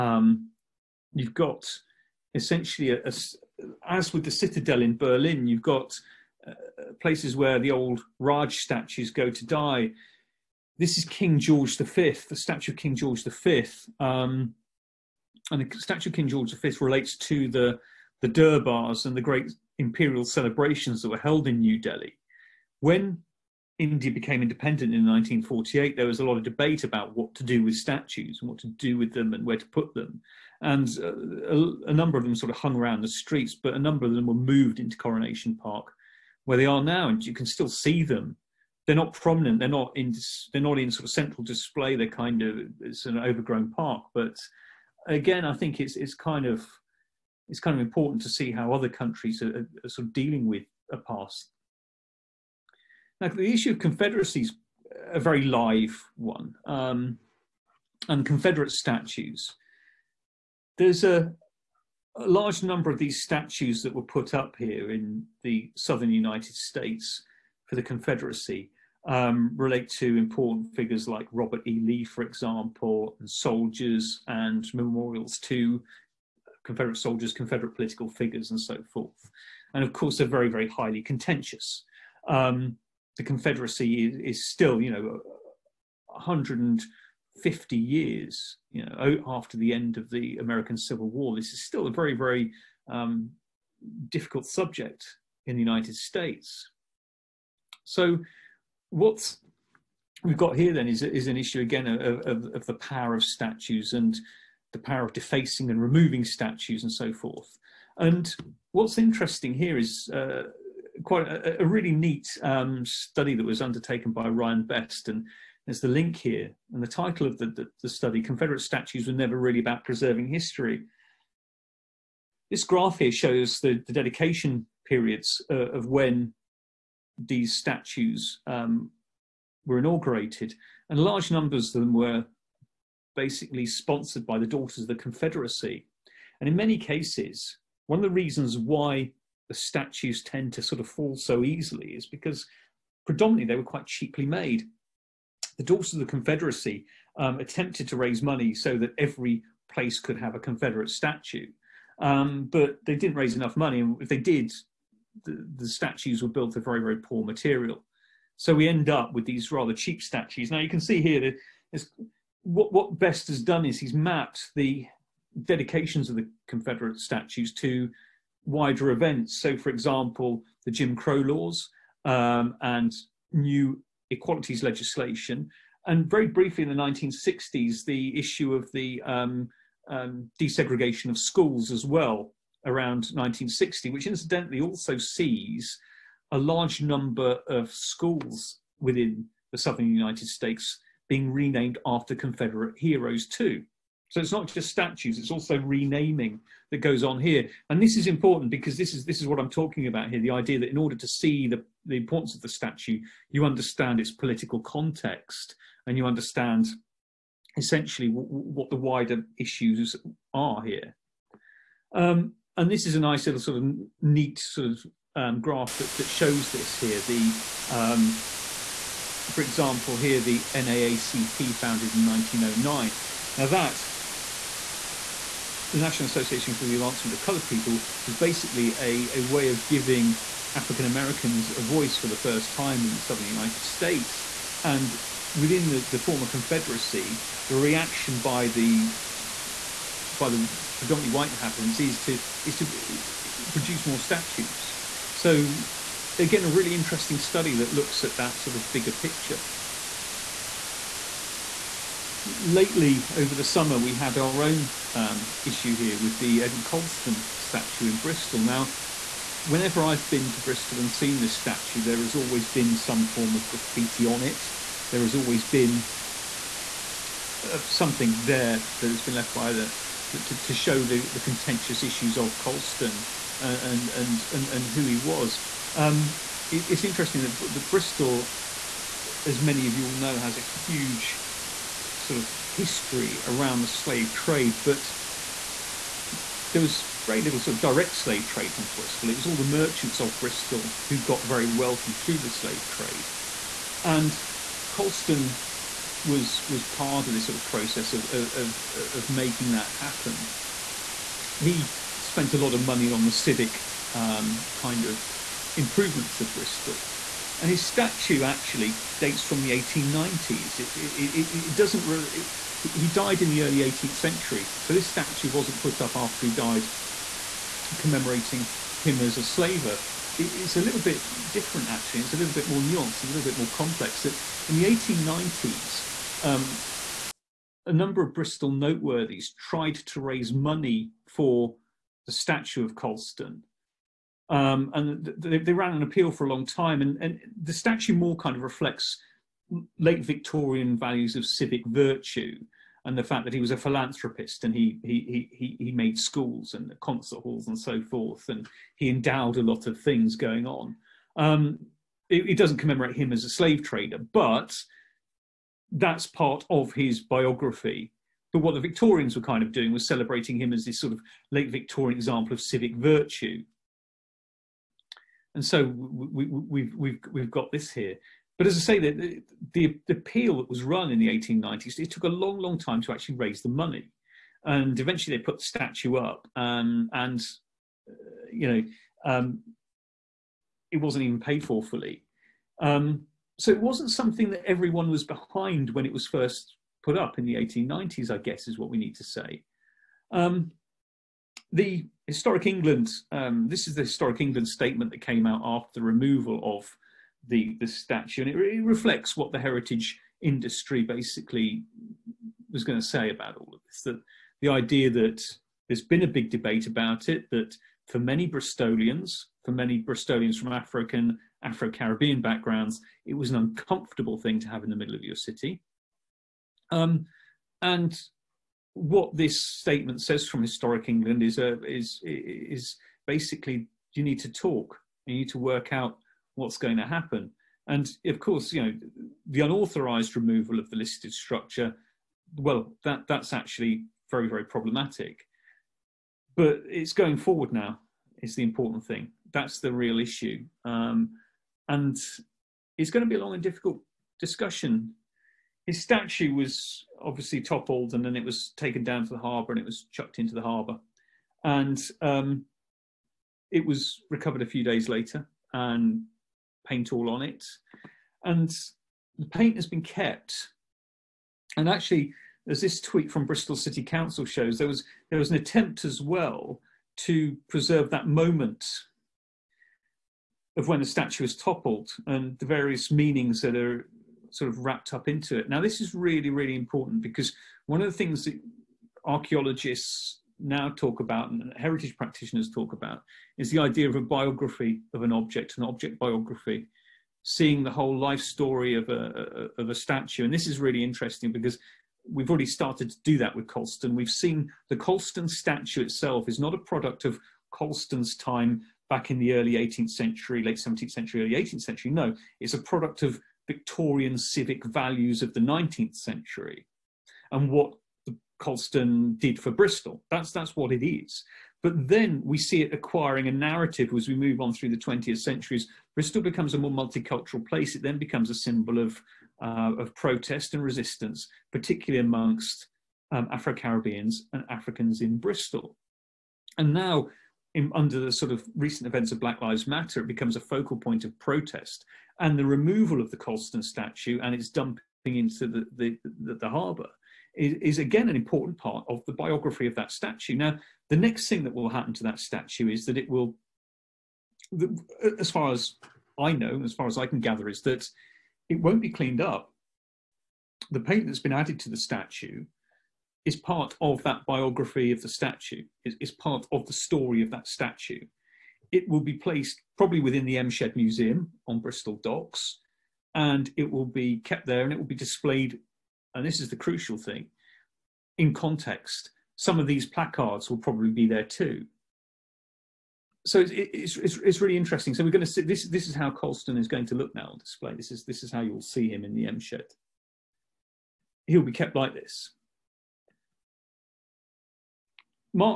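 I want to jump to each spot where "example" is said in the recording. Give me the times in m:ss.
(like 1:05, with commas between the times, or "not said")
1:12, 2:49, 3:39, 6:01.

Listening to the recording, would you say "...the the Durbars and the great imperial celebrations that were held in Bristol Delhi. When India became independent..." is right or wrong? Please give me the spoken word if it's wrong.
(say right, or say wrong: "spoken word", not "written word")
wrong: "New", not "Bristol".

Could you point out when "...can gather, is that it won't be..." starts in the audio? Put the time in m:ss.
9:07.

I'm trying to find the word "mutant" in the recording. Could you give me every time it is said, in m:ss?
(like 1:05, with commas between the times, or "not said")
not said.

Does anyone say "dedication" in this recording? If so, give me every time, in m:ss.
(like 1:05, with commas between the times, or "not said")
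2:03, 2:45.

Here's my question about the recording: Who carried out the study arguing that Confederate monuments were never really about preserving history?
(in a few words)
Ryan Best.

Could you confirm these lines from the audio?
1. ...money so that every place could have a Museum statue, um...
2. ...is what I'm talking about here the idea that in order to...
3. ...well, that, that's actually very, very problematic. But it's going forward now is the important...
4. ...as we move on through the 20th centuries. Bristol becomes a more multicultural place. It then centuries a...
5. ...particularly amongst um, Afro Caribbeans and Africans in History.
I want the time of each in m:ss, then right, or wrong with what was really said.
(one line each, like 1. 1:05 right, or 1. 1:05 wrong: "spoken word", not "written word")
1. 2:28 wrong: "Confederate", not "Museum"
2. 3:19 right
3. 7:12 right
4. 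8:33 wrong: "becomes", not "centuries"
5. 8:41 wrong: "Bristol", not "History".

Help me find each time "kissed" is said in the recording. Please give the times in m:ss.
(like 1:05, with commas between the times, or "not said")
not said.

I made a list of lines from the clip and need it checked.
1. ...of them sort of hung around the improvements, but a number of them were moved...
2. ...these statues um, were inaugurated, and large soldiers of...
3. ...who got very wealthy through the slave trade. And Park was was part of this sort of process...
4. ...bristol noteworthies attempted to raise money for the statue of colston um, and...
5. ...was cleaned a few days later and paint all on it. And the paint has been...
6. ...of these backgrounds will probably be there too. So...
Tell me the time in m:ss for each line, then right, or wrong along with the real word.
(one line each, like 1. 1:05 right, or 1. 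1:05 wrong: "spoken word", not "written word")
1. 0:32 wrong: "streets", not "improvements"
2. 2:07 wrong: "numbers", not "soldiers"
3. 4:50 wrong: "Colston", not "Park"
4. 5:28 wrong: "tried", not "attempted"
5. 7:33 wrong: "recovered", not "cleaned"
6. 9:29 wrong: "placards", not "backgrounds".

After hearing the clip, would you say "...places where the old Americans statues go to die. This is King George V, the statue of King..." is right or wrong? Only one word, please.
wrong.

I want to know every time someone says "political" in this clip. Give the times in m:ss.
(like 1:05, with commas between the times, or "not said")
1:17, 3:24.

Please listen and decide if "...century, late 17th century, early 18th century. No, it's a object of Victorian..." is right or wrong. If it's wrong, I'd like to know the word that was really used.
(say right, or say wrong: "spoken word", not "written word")
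wrong: "product", not "object".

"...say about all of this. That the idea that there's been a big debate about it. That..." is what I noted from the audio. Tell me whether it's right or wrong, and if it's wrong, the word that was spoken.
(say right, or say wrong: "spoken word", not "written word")
right.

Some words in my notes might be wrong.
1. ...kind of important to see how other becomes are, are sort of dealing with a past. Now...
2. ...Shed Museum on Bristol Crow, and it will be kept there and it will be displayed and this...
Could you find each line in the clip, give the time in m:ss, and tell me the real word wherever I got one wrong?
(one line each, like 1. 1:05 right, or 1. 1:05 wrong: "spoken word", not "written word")
1. 0:47 wrong: "countries", not "becomes"
2. 9:20 wrong: "Docks", not "Crow".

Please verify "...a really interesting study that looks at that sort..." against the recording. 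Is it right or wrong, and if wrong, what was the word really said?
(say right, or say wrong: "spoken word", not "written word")
right.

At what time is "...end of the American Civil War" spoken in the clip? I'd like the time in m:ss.
1:29.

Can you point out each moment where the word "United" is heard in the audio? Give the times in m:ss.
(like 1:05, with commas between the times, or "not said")
1:06, 1:35, 3:09, 3:53.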